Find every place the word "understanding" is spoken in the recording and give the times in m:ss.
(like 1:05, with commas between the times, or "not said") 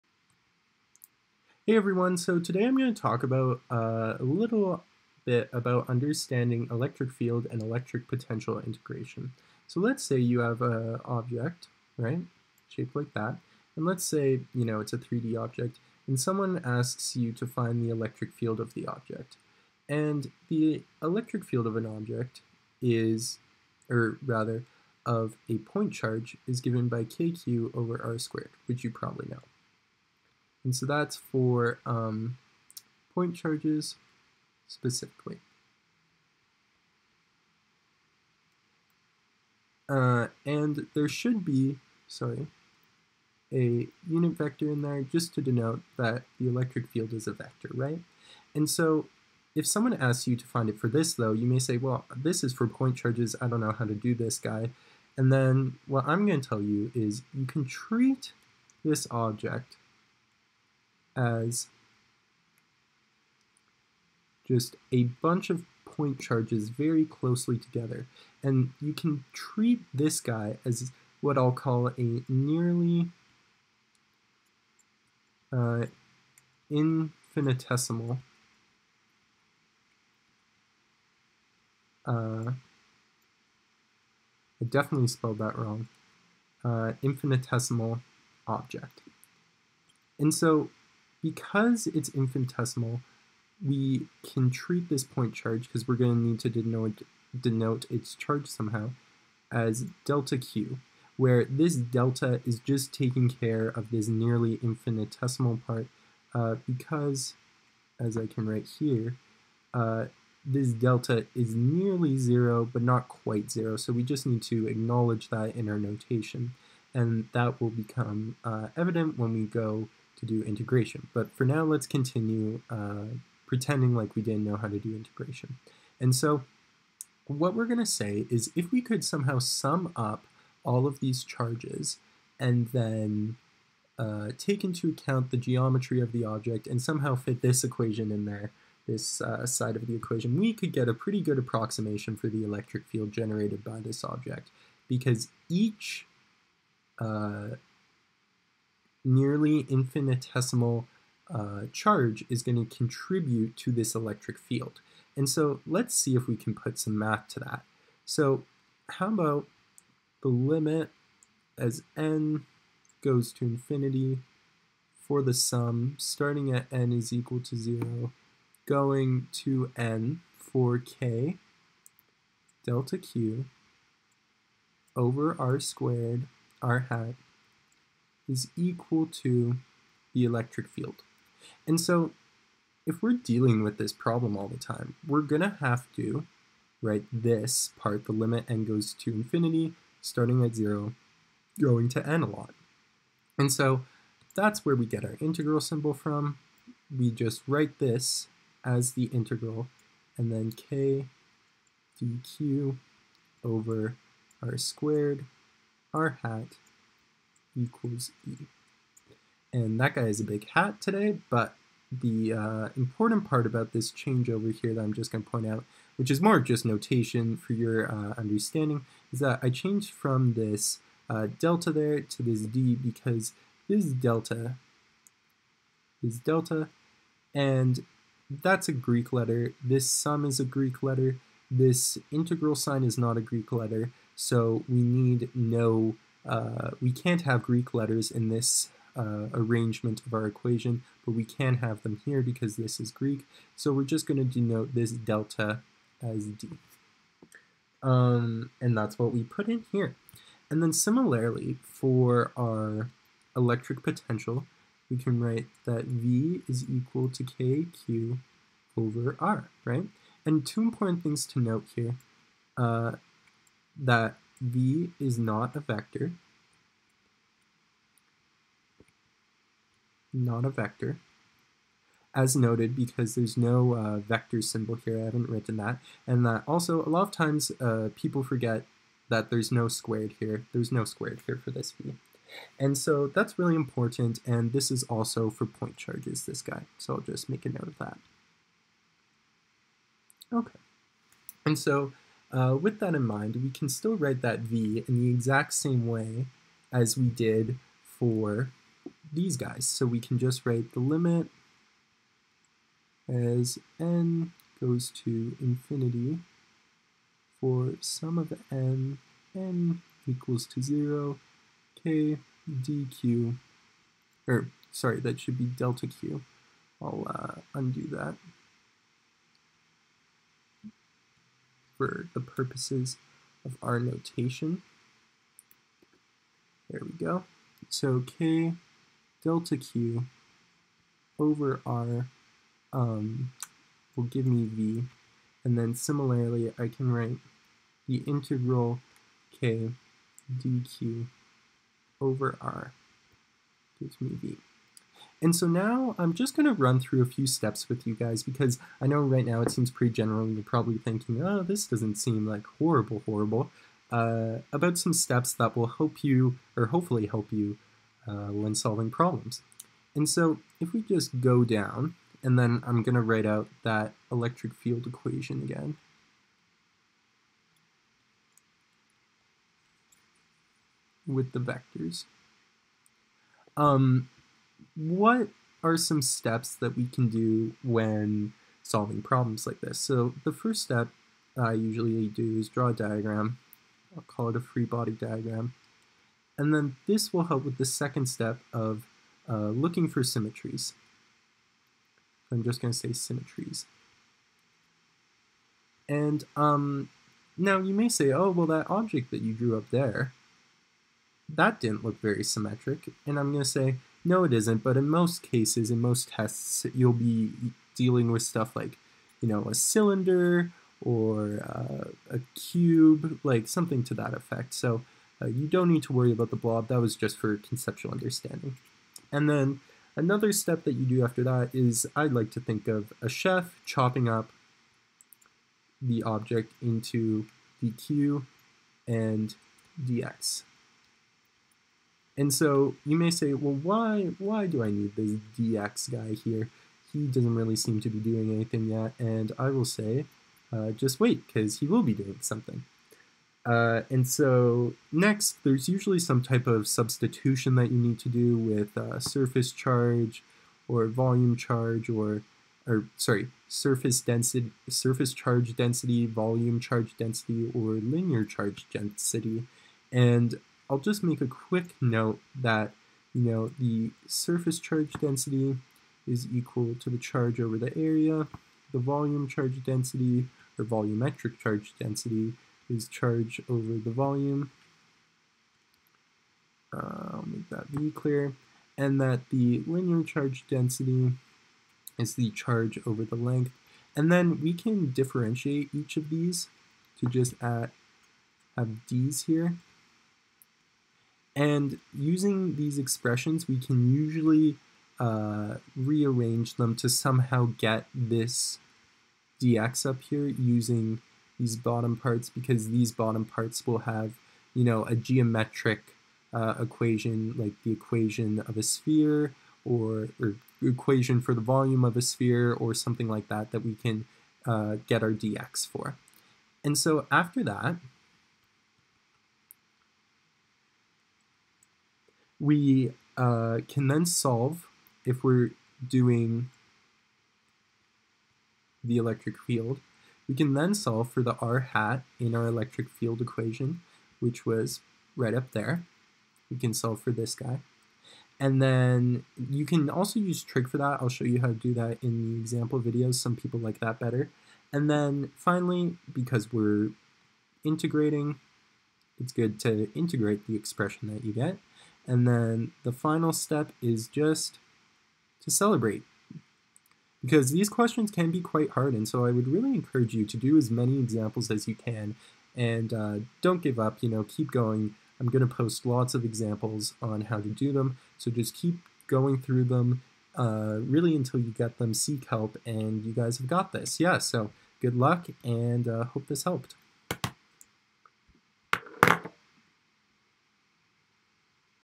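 0:05, 3:38, 6:57.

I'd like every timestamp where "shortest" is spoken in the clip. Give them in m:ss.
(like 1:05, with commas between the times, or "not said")
not said.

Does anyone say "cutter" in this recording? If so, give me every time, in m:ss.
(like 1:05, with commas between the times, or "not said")
not said.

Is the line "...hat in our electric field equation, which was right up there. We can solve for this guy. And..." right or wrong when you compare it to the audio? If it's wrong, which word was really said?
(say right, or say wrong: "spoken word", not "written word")
right.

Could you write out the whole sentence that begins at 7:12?
And so you may say, well, why, why do I need this DX guy here?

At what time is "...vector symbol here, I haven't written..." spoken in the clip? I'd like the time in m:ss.
4:33.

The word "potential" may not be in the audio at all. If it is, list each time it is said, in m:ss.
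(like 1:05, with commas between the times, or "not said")
0:08, 4:13.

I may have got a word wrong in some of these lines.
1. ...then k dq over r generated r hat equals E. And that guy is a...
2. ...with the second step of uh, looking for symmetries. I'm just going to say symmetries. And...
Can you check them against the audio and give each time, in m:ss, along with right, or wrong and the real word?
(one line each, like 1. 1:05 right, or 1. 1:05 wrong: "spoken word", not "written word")
1. 3:20 wrong: "squared", not "generated"
2. 6:27 right.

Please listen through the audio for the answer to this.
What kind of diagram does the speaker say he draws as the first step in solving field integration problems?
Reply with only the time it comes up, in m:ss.
6:24.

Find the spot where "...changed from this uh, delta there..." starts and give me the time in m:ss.
3:39.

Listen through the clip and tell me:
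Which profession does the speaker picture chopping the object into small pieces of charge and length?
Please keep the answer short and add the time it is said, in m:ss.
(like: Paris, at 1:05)
chef, at 7:03.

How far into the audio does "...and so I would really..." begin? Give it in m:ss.
9:18.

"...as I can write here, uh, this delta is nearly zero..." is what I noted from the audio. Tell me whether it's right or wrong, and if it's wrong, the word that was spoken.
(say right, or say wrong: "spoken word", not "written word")
right.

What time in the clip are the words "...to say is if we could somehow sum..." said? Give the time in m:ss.
2:07.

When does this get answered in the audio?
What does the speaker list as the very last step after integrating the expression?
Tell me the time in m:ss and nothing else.
9:15.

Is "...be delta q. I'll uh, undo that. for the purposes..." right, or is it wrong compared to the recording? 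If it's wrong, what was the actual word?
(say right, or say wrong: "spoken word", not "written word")
right.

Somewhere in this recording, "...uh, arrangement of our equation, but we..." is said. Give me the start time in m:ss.
3:58.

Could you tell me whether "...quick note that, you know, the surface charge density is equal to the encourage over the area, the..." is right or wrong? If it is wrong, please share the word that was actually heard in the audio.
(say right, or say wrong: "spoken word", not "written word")
wrong: "charge", not "encourage".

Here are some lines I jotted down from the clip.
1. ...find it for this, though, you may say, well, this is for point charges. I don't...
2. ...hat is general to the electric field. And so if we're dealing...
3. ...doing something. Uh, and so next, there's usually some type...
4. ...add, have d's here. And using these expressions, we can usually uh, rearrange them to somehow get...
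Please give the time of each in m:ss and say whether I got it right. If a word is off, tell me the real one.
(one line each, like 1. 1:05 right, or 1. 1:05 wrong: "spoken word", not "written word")
1. 0:50 right
2. 2:56 wrong: "equal", not "general"
3. 7:21 right
4. 8:07 right.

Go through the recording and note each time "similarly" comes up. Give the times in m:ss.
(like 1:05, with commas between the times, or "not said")
4:10, 5:35.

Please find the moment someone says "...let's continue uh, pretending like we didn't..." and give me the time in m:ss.
2:01.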